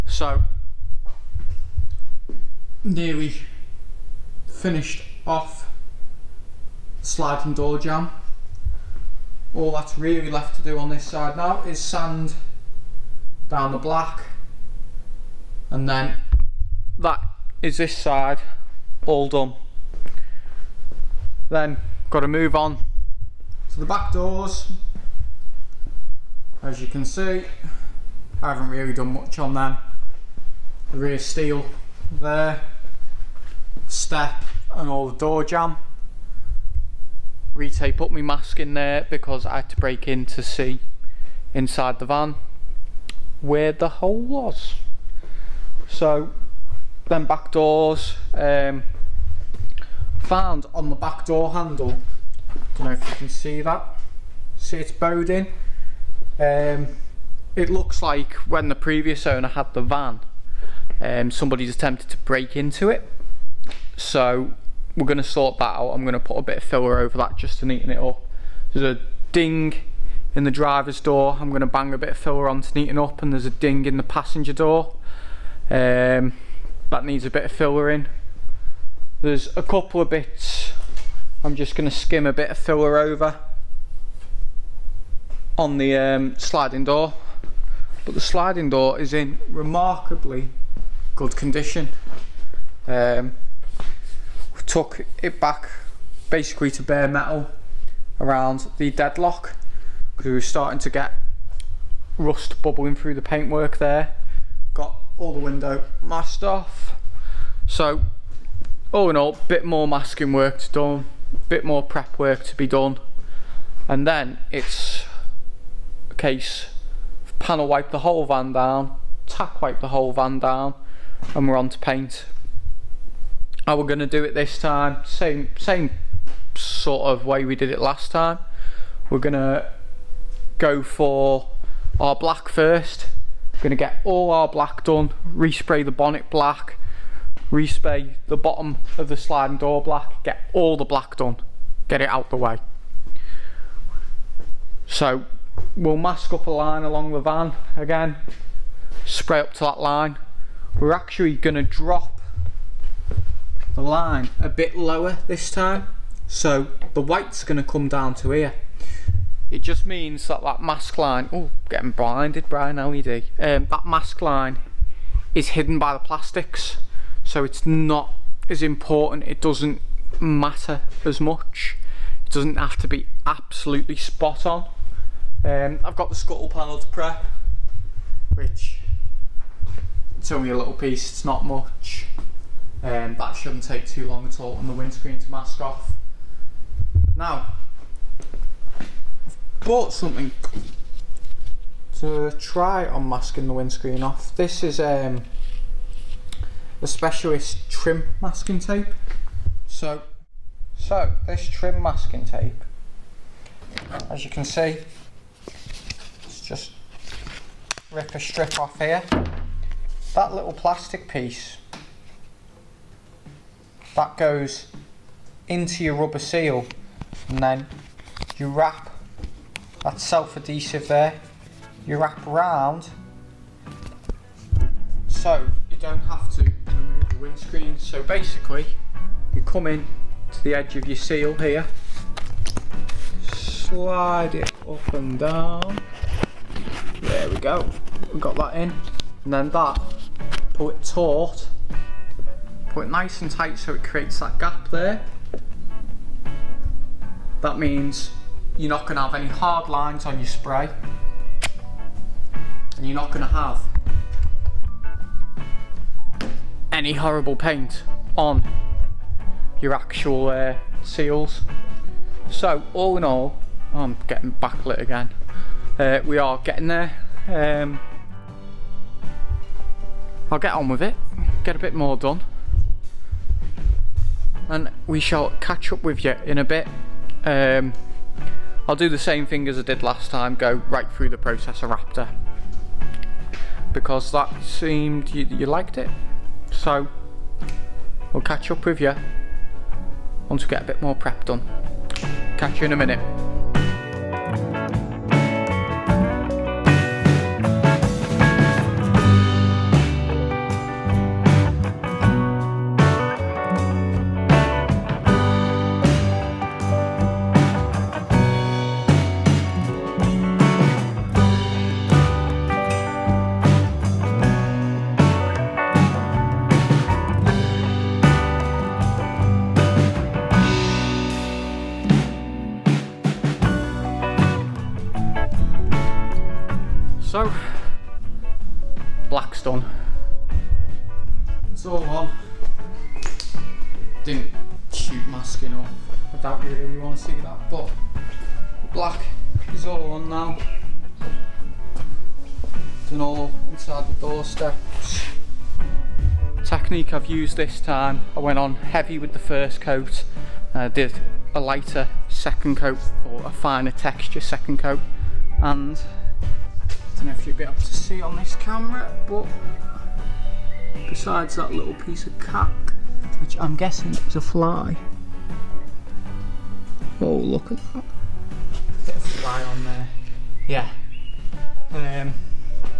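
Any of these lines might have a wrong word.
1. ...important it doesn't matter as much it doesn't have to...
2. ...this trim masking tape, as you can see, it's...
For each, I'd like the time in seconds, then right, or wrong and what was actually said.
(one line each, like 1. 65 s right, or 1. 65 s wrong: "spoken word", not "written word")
1. 168 s right
2. 201 s right.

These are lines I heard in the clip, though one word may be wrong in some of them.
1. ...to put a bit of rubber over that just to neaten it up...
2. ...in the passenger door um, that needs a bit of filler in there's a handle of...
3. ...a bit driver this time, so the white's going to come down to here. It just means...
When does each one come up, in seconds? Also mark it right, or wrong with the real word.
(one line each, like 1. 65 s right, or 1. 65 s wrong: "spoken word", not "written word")
1. 66 s wrong: "filler", not "rubber"
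2. 73 s wrong: "couple", not "handle"
3. 154 s wrong: "lower", not "driver".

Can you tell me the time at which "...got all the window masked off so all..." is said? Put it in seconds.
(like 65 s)
104 s.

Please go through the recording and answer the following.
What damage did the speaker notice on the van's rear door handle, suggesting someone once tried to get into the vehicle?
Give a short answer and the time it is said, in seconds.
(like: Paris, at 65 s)
bowed in, at 54 s.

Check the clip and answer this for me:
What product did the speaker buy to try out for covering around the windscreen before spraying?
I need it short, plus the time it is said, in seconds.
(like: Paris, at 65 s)
Specialist Trim Masking Tape, at 196 s.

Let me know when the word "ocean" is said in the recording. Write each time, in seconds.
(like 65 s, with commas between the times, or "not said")
not said.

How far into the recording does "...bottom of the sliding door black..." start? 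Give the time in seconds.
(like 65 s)
138 s.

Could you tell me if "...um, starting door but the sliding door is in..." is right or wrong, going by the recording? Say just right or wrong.
wrong.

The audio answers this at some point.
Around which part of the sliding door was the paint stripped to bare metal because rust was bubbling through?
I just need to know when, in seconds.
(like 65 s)
98 s.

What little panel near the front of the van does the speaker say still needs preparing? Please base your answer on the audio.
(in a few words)
scuttle panel.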